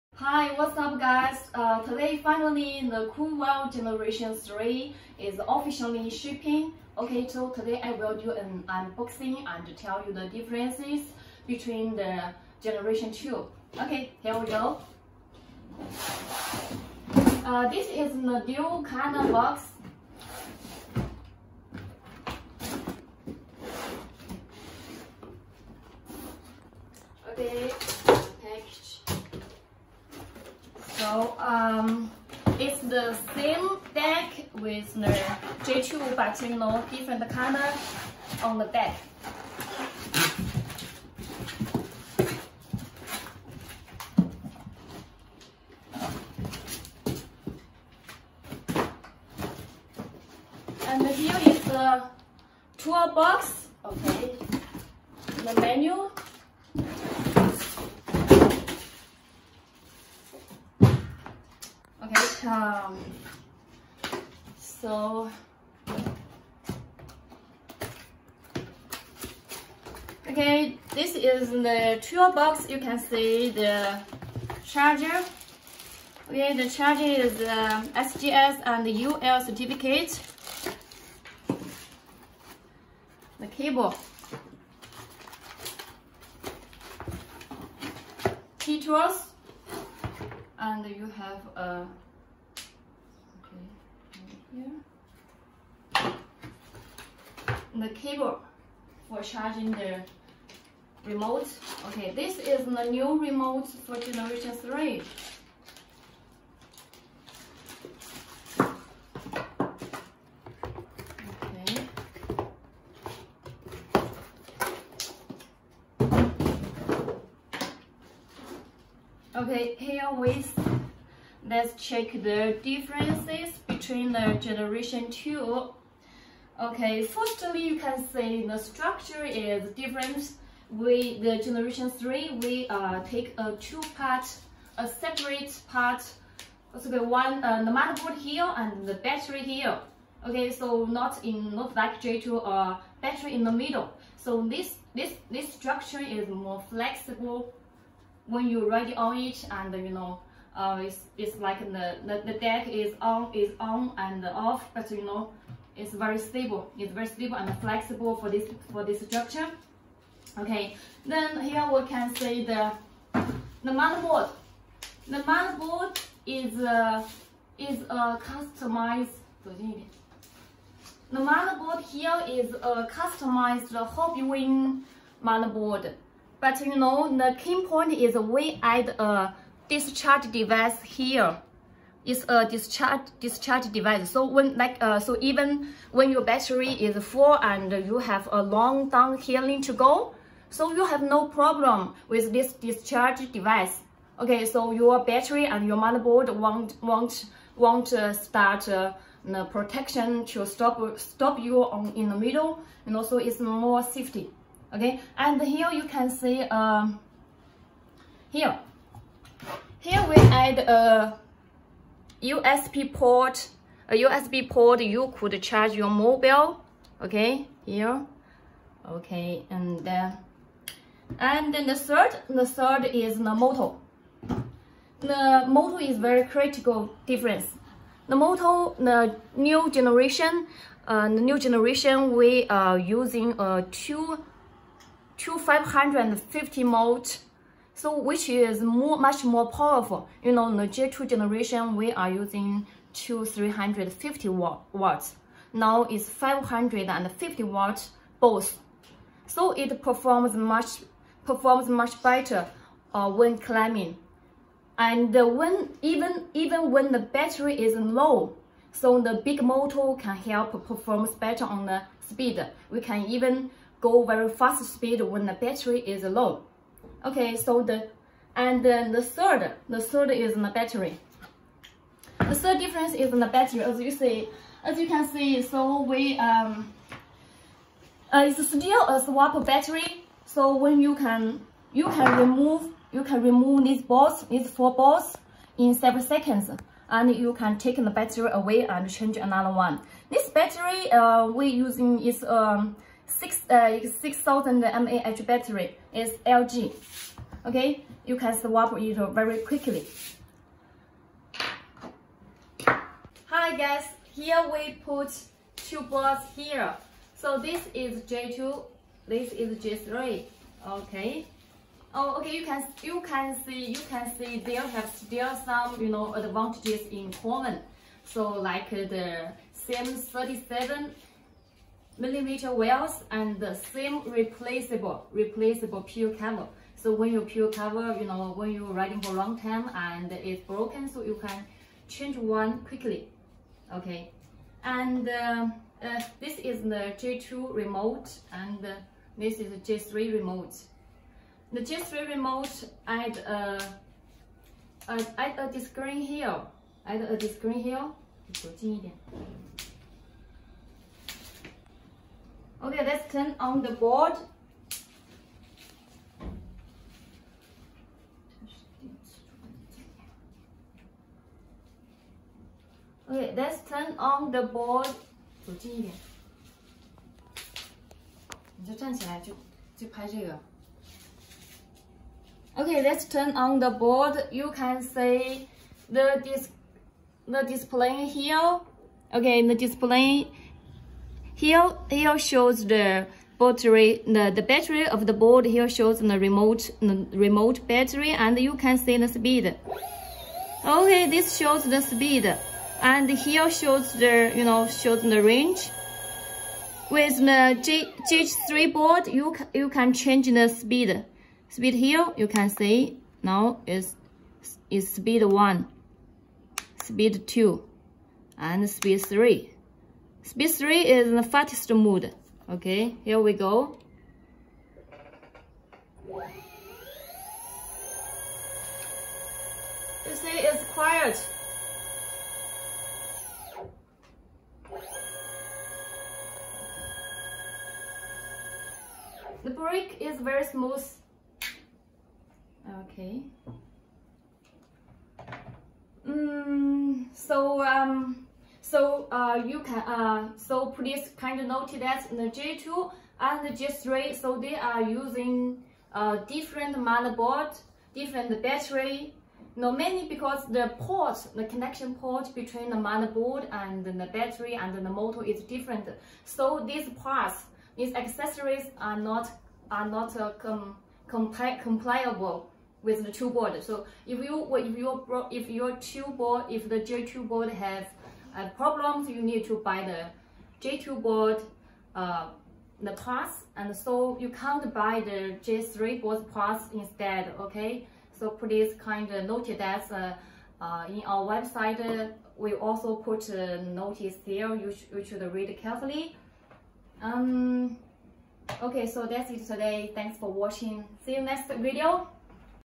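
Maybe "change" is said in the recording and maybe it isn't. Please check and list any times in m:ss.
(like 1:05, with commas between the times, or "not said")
4:48, 5:31, 6:39.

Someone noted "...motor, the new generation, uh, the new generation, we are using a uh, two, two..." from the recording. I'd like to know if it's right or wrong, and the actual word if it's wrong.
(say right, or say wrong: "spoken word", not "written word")
right.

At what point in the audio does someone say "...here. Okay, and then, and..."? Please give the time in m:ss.
3:37.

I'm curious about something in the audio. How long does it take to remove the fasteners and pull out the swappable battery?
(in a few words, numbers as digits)
7 seconds.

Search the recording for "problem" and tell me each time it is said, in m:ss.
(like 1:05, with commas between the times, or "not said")
3:11, 7:48.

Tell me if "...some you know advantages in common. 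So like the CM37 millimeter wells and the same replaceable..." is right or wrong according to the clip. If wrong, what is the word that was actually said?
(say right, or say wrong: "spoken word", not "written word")
right.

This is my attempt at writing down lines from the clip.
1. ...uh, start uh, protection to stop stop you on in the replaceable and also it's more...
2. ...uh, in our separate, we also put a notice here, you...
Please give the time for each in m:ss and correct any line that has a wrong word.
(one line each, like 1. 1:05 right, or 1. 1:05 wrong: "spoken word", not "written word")
1. 3:17 wrong: "middle", not "replaceable"
2. 8:00 wrong: "website", not "separate".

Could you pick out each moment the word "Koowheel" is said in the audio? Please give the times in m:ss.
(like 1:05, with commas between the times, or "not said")
0:03.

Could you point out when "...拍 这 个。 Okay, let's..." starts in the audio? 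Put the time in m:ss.
6:09.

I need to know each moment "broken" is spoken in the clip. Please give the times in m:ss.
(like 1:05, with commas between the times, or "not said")
5:30.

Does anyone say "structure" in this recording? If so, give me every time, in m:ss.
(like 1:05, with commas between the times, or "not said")
2:08, 2:25, 2:39.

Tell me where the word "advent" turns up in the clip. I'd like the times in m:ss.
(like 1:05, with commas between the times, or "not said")
not said.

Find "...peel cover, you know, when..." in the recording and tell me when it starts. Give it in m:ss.
5:27.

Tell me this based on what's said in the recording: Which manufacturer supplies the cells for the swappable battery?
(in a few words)
LG.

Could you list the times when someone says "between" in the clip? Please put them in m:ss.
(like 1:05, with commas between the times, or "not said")
0:11, 2:03, 7:32.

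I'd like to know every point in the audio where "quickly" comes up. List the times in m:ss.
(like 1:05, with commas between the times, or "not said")
4:59, 5:32.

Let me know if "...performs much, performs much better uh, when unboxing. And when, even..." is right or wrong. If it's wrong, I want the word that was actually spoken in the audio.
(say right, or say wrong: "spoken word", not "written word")
wrong: "climbing", not "unboxing".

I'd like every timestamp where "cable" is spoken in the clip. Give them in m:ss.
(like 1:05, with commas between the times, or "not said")
1:23, 1:37.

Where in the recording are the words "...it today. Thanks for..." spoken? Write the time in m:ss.
8:09.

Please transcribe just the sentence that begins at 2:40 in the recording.
Okay, then here we can see the the motherboard.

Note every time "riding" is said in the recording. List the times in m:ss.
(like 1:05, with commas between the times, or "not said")
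5:28.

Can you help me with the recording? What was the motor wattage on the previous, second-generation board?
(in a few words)
350 watts.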